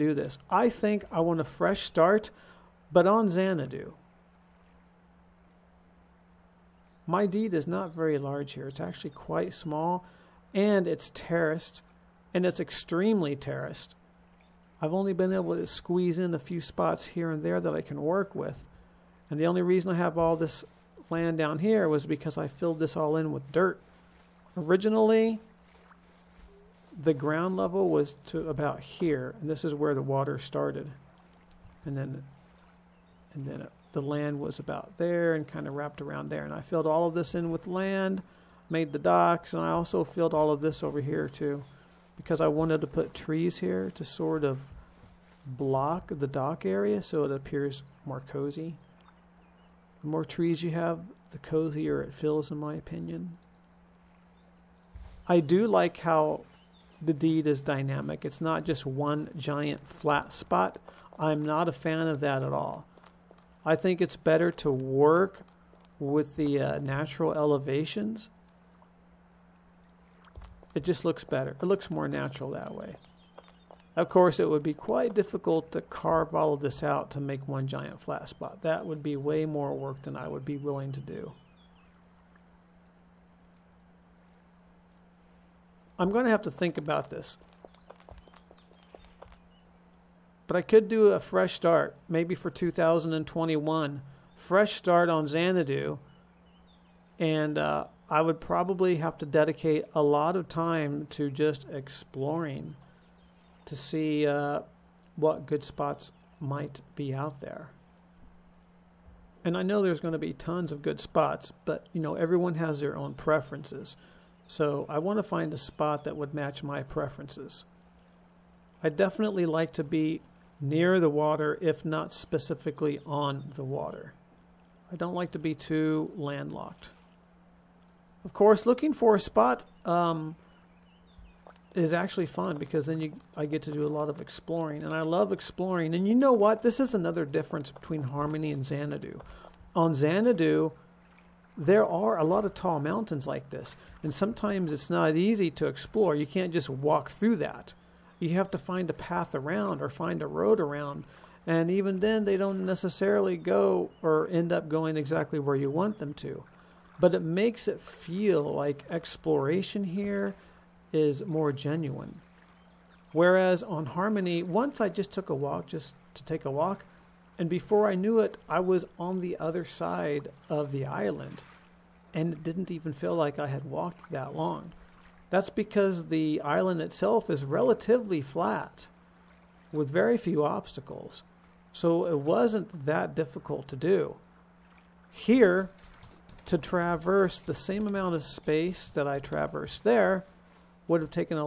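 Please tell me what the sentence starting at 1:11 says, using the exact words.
It looks more natural that way.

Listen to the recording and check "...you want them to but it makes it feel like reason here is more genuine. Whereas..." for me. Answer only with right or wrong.
wrong.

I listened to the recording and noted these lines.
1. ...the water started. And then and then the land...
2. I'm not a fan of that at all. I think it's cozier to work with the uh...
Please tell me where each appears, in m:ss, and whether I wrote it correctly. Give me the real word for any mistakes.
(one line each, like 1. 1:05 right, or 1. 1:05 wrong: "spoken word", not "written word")
1. 0:29 right
2. 1:01 wrong: "better", not "cozier".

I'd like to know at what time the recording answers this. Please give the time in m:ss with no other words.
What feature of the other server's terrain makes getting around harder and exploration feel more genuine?
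2:22.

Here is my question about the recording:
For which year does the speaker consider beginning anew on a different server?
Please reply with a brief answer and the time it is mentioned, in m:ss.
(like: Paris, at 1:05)
2021, at 1:32.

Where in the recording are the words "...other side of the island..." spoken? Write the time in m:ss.
2:49.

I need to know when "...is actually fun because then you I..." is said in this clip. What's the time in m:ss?
2:11.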